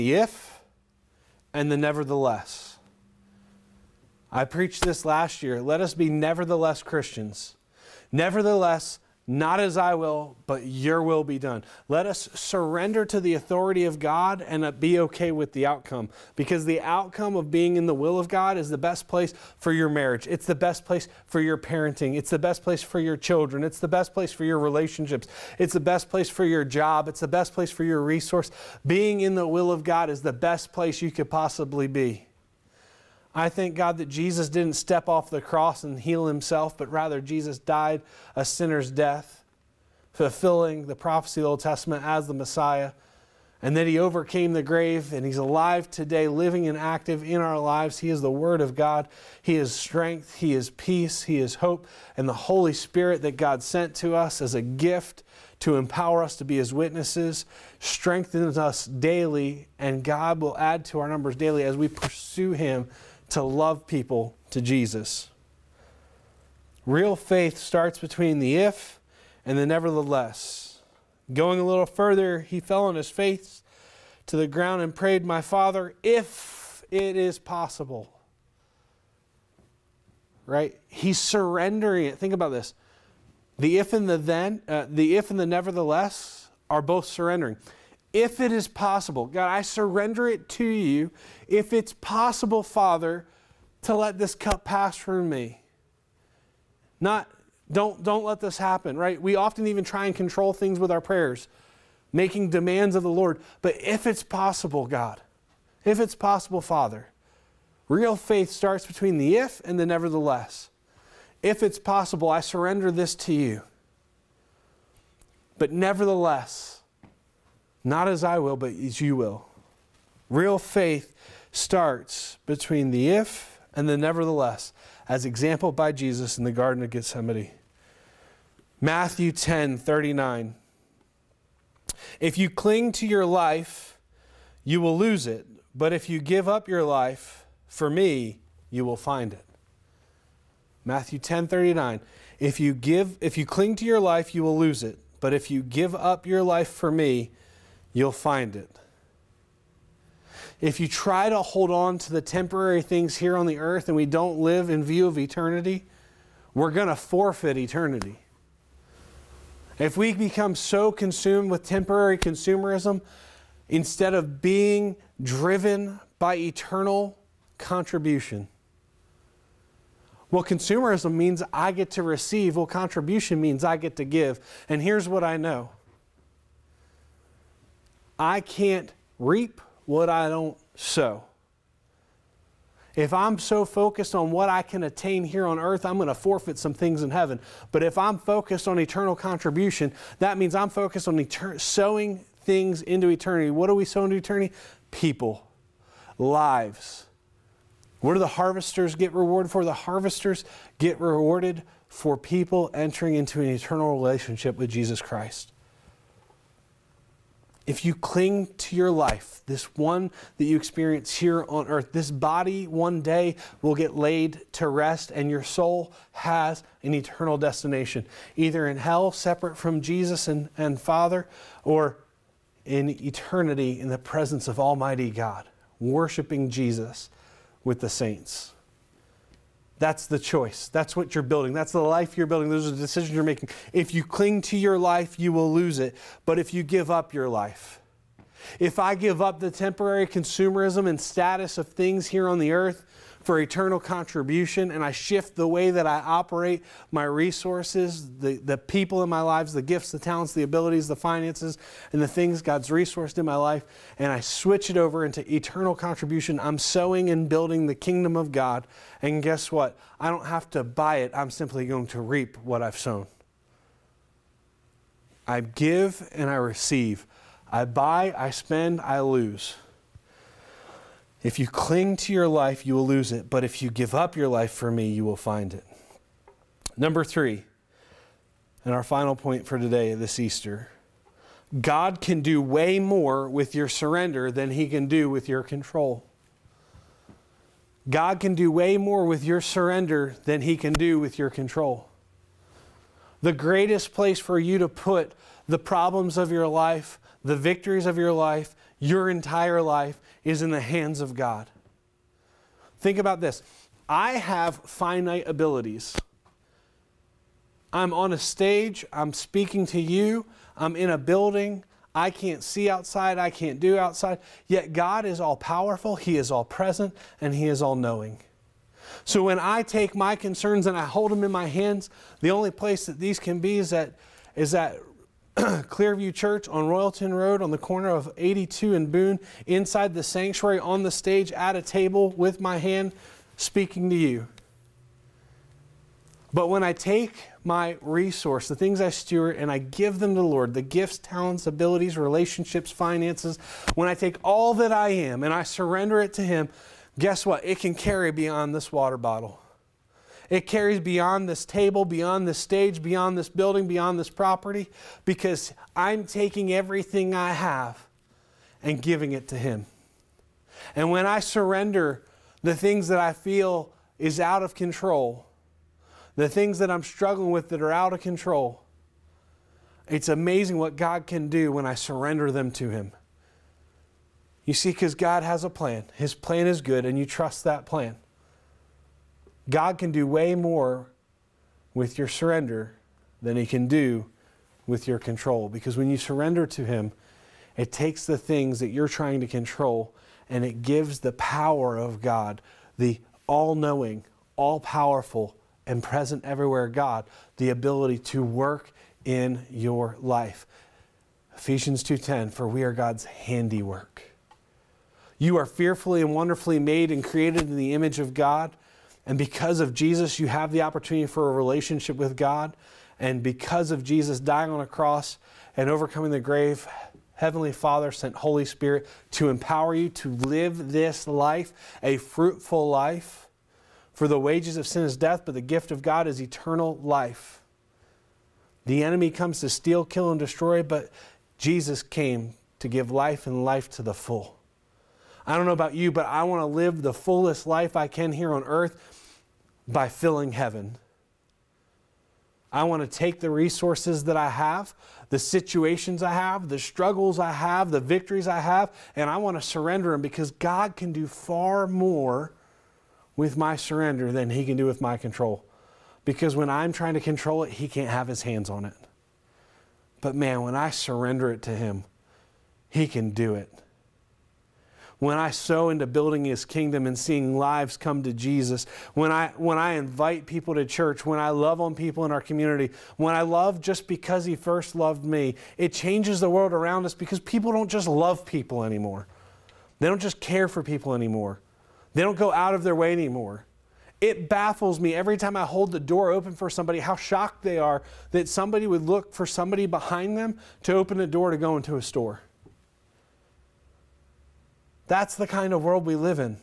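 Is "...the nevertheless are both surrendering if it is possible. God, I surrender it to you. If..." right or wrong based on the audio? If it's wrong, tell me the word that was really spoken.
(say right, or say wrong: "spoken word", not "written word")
right.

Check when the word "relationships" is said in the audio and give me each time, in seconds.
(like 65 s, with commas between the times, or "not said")
24 s, 203 s, 341 s, 411 s.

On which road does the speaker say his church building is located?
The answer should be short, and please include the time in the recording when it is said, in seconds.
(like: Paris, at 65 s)
Royalton Road, at 326 s.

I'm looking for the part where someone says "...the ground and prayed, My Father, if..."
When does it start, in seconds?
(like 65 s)
74 s.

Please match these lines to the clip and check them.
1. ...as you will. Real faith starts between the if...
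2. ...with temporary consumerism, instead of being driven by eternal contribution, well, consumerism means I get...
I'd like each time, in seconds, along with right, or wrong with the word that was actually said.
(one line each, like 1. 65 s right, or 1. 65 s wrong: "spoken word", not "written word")
1. 118 s right
2. 161 s right.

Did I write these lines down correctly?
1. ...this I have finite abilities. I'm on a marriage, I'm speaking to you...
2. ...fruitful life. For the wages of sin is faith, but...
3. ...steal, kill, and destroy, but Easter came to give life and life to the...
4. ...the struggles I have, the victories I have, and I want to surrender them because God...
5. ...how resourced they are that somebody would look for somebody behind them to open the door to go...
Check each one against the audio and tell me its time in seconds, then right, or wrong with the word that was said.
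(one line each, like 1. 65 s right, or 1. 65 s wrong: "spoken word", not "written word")
1. 303 s wrong: "stage", not "marriage"
2. 421 s wrong: "death", not "faith"
3. 429 s wrong: "Jesus", not "Easter"
4. 446 s right
5. 486 s wrong: "shocked", not "resourced".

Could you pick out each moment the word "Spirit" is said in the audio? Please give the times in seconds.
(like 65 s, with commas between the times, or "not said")
52 s, 418 s.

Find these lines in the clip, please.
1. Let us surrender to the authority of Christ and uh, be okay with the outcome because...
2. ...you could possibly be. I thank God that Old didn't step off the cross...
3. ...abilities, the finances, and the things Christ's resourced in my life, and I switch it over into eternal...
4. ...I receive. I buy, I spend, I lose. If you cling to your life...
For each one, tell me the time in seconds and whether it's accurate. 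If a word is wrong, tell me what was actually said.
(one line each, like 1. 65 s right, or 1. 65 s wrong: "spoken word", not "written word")
1. 11 s wrong: "God", not "Christ"
2. 31 s wrong: "Jesus", not "Old"
3. 250 s wrong: "God", not "Christ"
4. 266 s right.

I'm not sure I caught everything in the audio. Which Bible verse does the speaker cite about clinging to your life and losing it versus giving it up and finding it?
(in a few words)
Matthew 10:39.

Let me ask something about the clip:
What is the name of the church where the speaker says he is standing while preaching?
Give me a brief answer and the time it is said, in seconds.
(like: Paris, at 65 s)
Clearview Church, at 325 s.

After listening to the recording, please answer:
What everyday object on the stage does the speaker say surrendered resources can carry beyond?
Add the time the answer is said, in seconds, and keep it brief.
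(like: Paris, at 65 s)
water bottle, at 348 s.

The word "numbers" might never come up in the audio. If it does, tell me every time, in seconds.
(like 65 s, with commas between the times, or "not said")
61 s, 276 s.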